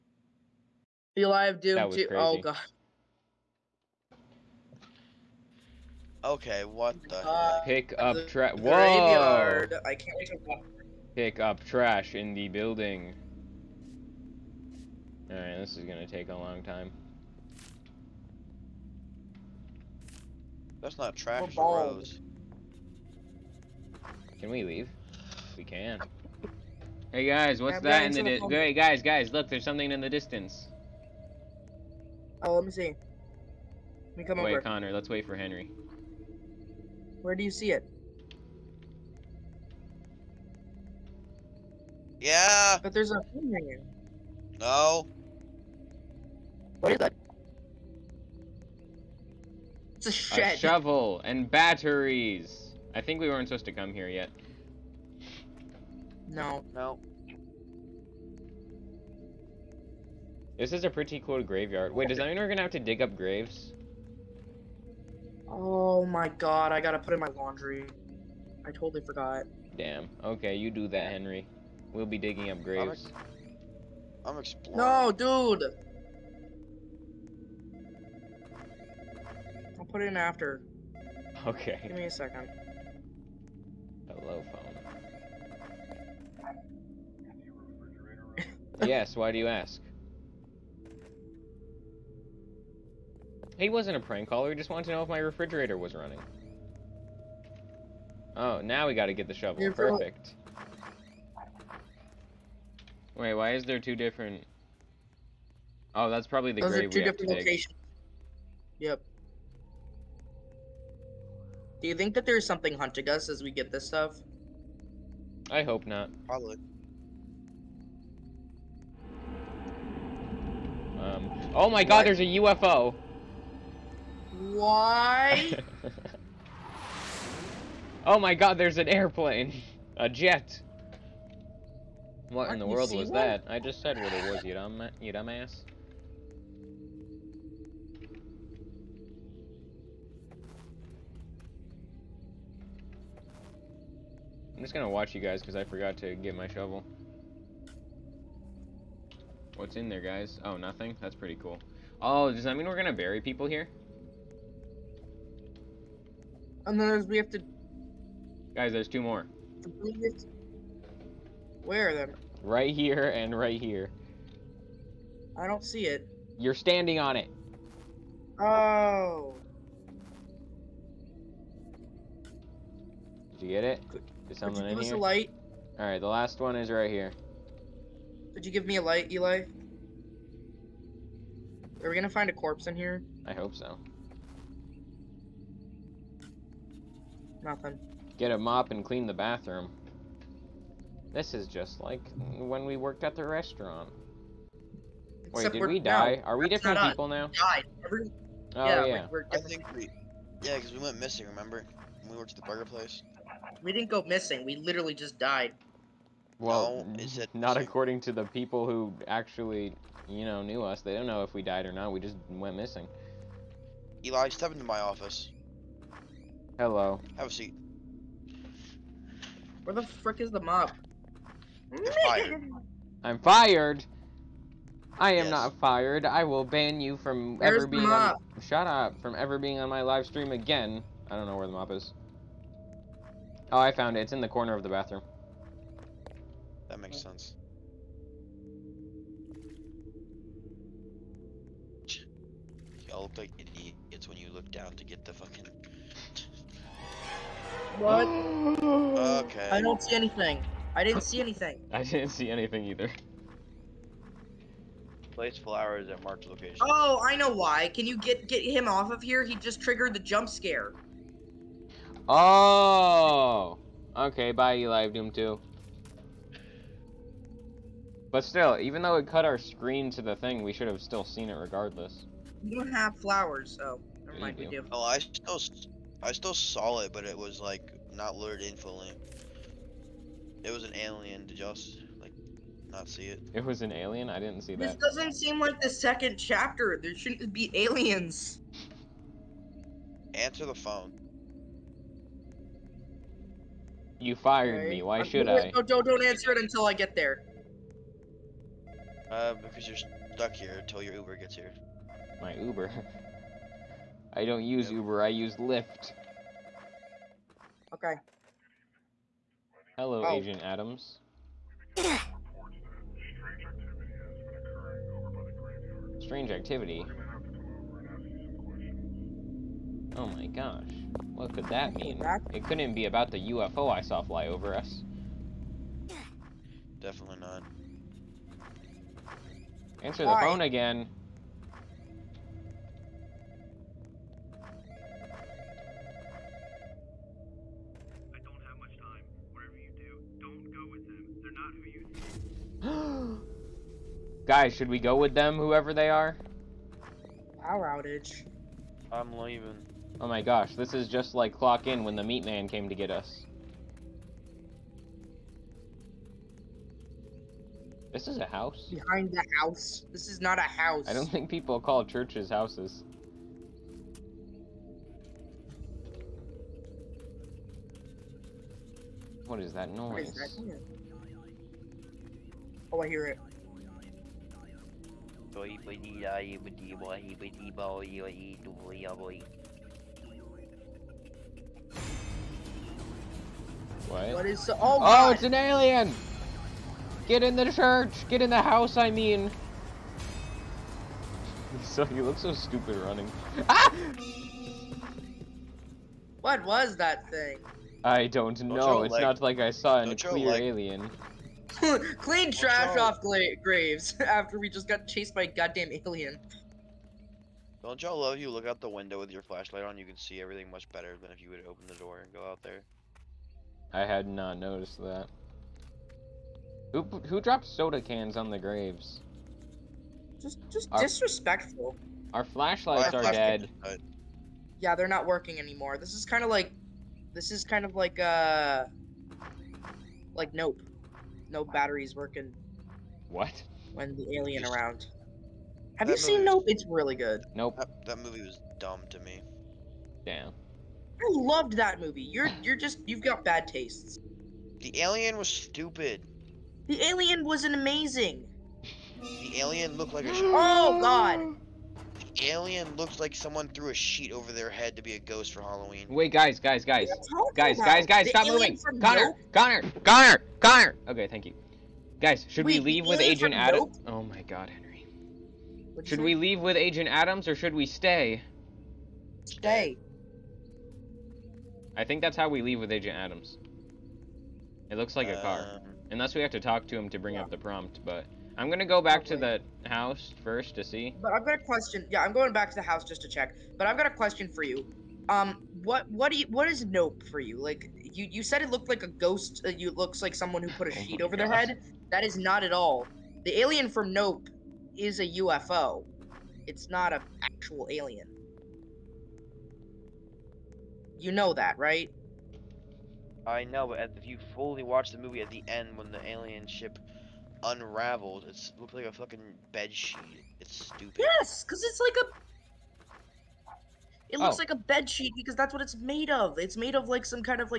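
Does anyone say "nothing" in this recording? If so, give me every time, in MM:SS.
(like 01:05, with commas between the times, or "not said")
02:30, 03:07.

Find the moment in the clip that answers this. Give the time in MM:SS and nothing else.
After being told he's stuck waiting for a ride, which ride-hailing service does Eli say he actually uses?
05:05.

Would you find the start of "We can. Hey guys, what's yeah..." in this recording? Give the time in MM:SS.
00:25.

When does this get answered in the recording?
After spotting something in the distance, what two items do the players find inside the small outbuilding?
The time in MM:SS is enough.
00:50.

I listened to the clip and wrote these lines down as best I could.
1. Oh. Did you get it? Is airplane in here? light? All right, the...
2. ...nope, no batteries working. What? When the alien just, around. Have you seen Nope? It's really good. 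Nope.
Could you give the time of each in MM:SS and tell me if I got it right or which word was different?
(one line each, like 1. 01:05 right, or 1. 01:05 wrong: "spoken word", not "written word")
1. 02:48 wrong: "someone", not "airplane"
2. 07:10 right.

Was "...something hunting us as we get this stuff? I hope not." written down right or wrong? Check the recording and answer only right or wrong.
right.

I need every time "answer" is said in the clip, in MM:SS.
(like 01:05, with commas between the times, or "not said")
04:50, 04:56, 05:29.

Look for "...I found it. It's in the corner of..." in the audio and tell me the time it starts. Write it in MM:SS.
03:53.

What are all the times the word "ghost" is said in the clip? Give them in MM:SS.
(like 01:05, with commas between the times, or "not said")
07:34, 08:08.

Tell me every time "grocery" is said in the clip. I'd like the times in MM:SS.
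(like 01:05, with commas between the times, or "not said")
not said.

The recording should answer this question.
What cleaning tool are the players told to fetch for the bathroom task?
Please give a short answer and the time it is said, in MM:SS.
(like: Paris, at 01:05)
A mop, at 03:08.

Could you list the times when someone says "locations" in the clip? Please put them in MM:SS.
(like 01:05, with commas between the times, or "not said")
01:47, 04:16.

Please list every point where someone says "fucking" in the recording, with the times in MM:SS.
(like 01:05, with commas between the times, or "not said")
04:05, 08:28.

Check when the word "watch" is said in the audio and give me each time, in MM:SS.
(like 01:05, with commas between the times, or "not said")
02:24, 08:24.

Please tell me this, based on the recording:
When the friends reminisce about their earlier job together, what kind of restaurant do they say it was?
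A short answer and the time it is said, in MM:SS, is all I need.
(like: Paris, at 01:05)
Burger place, at 03:22.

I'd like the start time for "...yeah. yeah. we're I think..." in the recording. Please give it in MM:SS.
03:18.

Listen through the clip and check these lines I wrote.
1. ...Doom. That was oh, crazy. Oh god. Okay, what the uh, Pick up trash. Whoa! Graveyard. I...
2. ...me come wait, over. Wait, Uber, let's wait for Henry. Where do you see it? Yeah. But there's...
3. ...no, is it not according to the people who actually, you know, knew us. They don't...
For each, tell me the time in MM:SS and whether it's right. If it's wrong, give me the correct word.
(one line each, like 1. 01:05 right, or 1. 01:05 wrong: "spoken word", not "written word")
1. 00:01 right
2. 00:34 wrong: "Connor", not "Uber"
3. 03:26 right.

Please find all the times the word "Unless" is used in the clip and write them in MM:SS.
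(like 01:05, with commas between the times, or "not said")
02:36, 07:55.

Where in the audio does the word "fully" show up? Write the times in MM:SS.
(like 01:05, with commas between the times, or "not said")
04:38, 08:24.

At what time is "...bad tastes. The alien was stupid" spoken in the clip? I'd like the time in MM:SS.
07:23.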